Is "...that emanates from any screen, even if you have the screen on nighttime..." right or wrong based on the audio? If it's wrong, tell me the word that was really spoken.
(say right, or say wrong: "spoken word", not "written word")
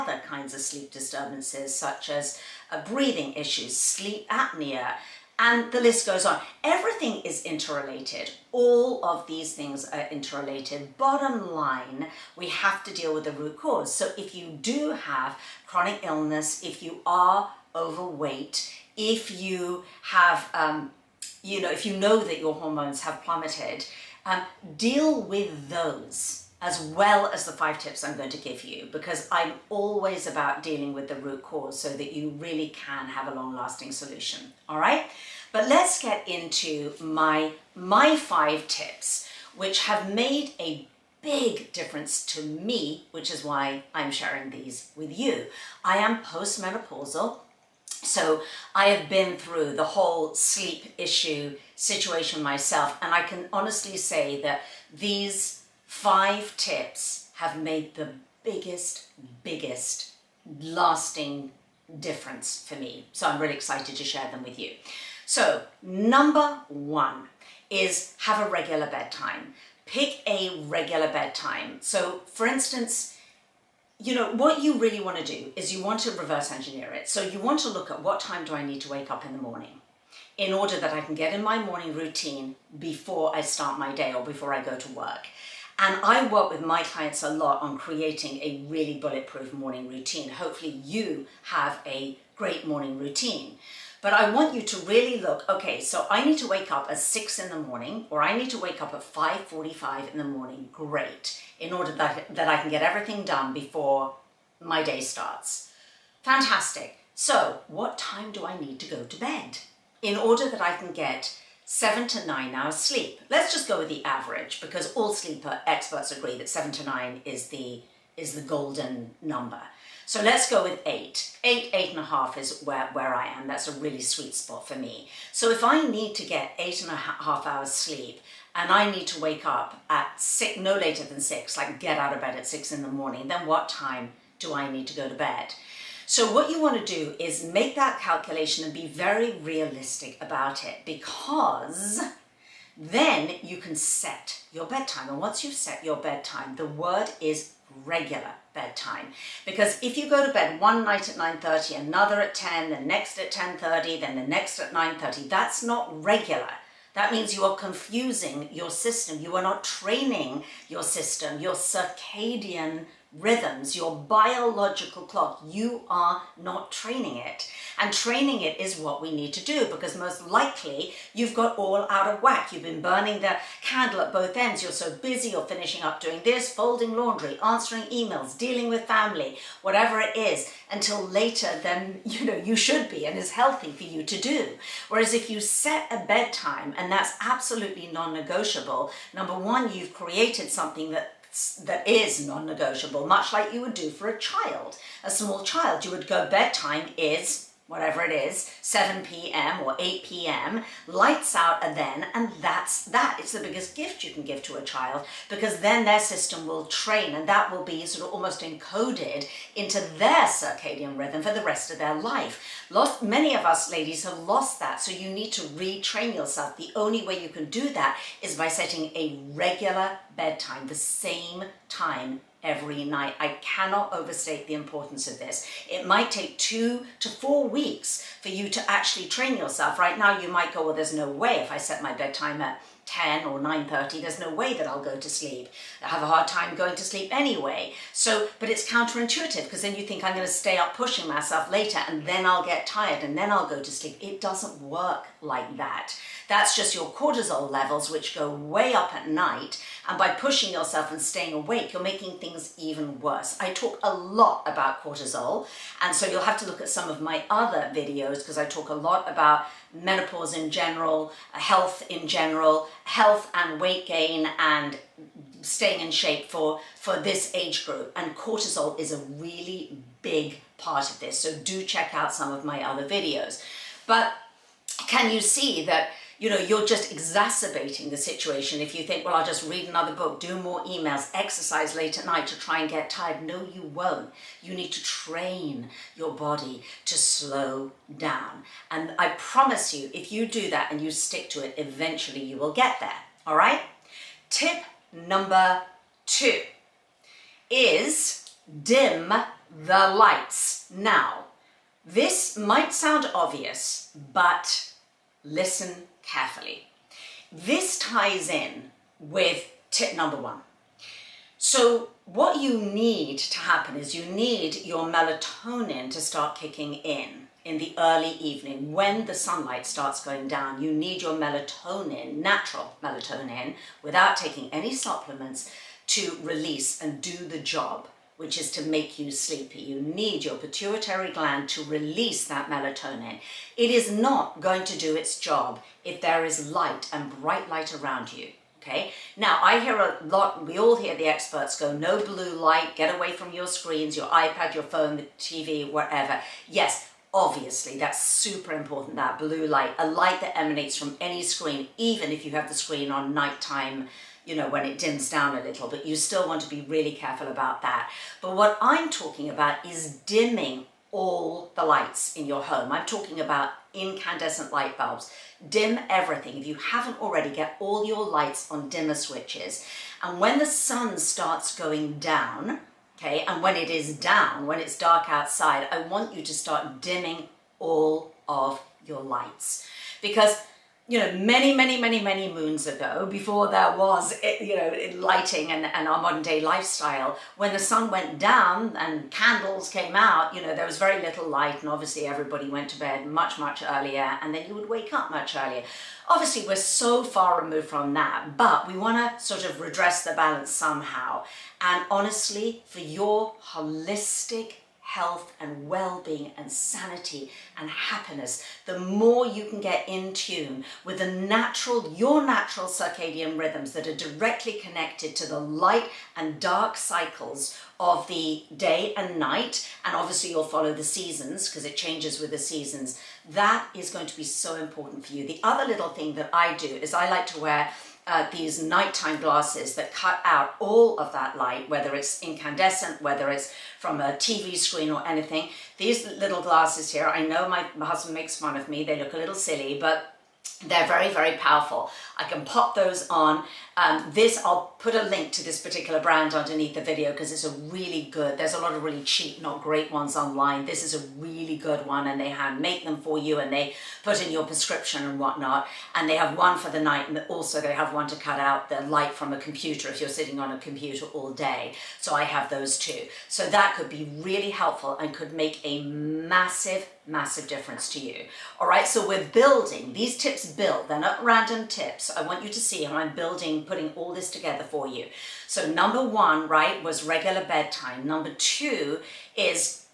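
right.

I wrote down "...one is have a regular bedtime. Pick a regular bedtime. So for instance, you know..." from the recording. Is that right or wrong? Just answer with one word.
right.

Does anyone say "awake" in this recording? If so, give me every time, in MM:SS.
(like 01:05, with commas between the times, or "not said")
04:11.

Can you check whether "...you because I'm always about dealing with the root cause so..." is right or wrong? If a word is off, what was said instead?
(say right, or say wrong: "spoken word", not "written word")
right.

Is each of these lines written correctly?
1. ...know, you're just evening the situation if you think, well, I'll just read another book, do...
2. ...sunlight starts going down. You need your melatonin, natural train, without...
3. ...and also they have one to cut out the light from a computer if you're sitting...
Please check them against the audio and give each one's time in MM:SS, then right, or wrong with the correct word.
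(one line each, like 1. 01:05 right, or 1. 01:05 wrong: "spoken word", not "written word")
1. 04:36 wrong: "exacerbating", not "evening"
2. 05:19 wrong: "melatonin", not "train"
3. 07:37 right.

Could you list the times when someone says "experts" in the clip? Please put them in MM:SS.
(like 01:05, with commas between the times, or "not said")
01:55, 05:41.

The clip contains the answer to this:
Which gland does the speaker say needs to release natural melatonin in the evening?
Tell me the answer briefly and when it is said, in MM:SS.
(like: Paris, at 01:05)
Pituitary gland, at 05:30.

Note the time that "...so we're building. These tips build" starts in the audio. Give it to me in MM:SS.
07:48.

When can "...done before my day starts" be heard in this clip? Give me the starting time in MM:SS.
01:43.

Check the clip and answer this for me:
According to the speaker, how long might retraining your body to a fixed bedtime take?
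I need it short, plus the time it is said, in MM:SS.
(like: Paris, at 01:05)
2 to 4 weeks, at 03:46.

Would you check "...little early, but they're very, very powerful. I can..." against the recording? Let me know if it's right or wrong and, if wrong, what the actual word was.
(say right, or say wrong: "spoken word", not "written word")
wrong: "silly", not "early".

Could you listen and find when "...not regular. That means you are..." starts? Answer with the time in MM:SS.
02:35.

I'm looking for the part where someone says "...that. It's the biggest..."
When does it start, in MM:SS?
03:22.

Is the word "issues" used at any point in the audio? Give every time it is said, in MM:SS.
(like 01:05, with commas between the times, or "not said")
00:03, 00:50.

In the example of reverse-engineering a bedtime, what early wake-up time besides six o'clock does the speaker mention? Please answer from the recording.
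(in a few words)
5:45.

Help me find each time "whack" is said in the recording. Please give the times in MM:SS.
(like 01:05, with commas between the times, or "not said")
02:52.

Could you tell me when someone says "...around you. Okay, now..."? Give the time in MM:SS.
05:37.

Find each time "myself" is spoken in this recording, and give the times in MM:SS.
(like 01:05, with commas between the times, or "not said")
00:52, 04:01.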